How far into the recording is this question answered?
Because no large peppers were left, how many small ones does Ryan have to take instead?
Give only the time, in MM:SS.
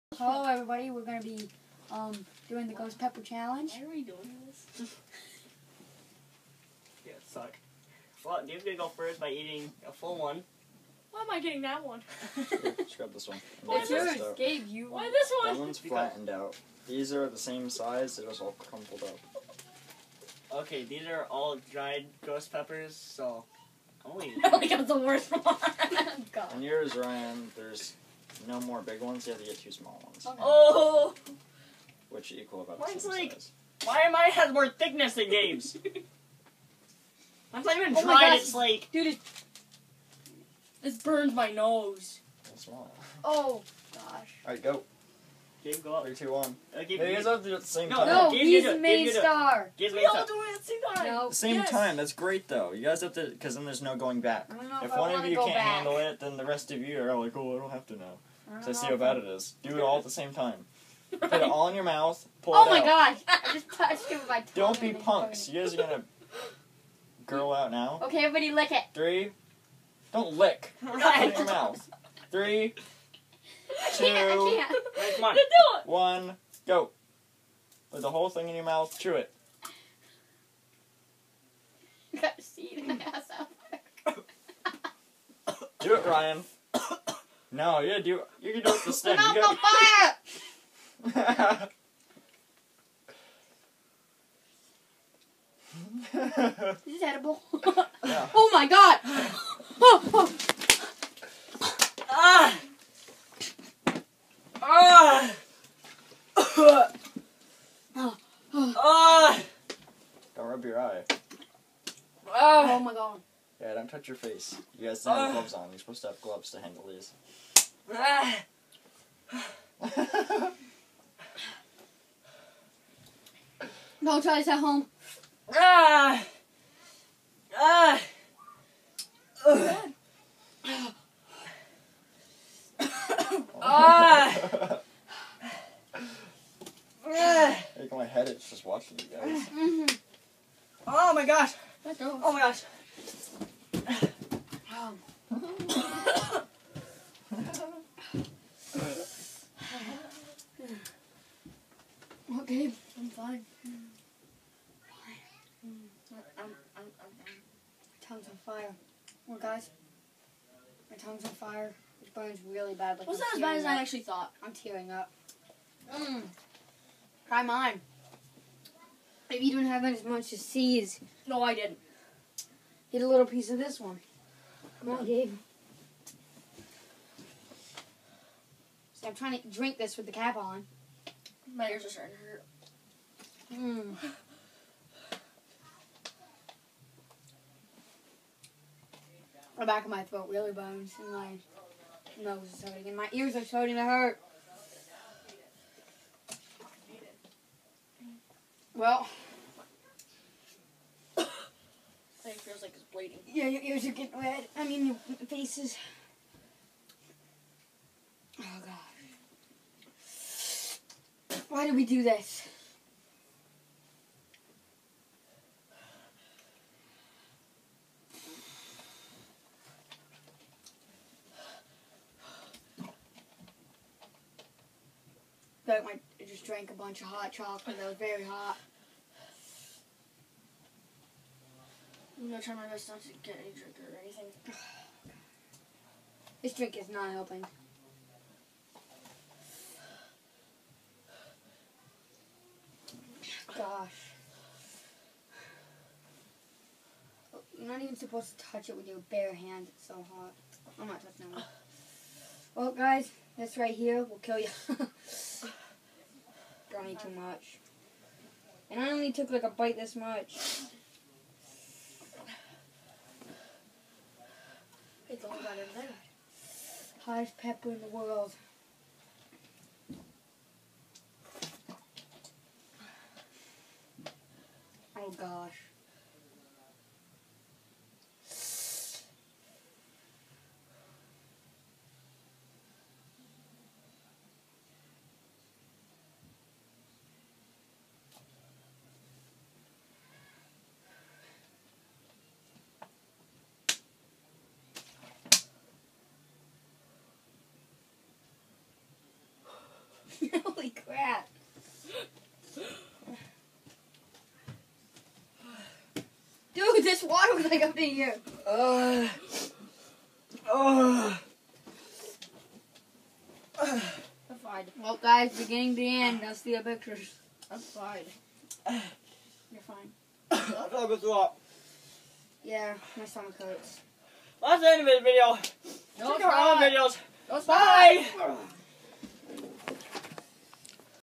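00:29.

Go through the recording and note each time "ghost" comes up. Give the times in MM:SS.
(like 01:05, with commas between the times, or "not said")
00:02, 00:22.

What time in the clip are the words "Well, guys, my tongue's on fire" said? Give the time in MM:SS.
02:39.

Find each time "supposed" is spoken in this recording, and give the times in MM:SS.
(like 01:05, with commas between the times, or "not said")
01:55, 04:07.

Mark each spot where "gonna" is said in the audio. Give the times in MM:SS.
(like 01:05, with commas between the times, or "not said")
00:01, 00:08, 01:05, 03:52.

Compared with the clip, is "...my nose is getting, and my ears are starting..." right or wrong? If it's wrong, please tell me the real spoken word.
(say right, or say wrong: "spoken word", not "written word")
wrong: "hurting", not "getting".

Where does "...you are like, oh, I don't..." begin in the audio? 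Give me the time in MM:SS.
00:56.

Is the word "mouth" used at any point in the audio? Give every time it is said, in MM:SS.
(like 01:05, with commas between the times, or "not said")
01:01, 01:11, 01:18.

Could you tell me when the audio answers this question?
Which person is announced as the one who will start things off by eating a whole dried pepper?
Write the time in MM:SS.
00:08.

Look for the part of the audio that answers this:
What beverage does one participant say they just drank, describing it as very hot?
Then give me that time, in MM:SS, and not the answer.
03:47.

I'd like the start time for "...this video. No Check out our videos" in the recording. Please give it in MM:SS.
05:24.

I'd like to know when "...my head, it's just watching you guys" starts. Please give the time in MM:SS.
02:17.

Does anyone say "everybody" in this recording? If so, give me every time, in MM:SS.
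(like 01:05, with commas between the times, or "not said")
00:00, 01:08.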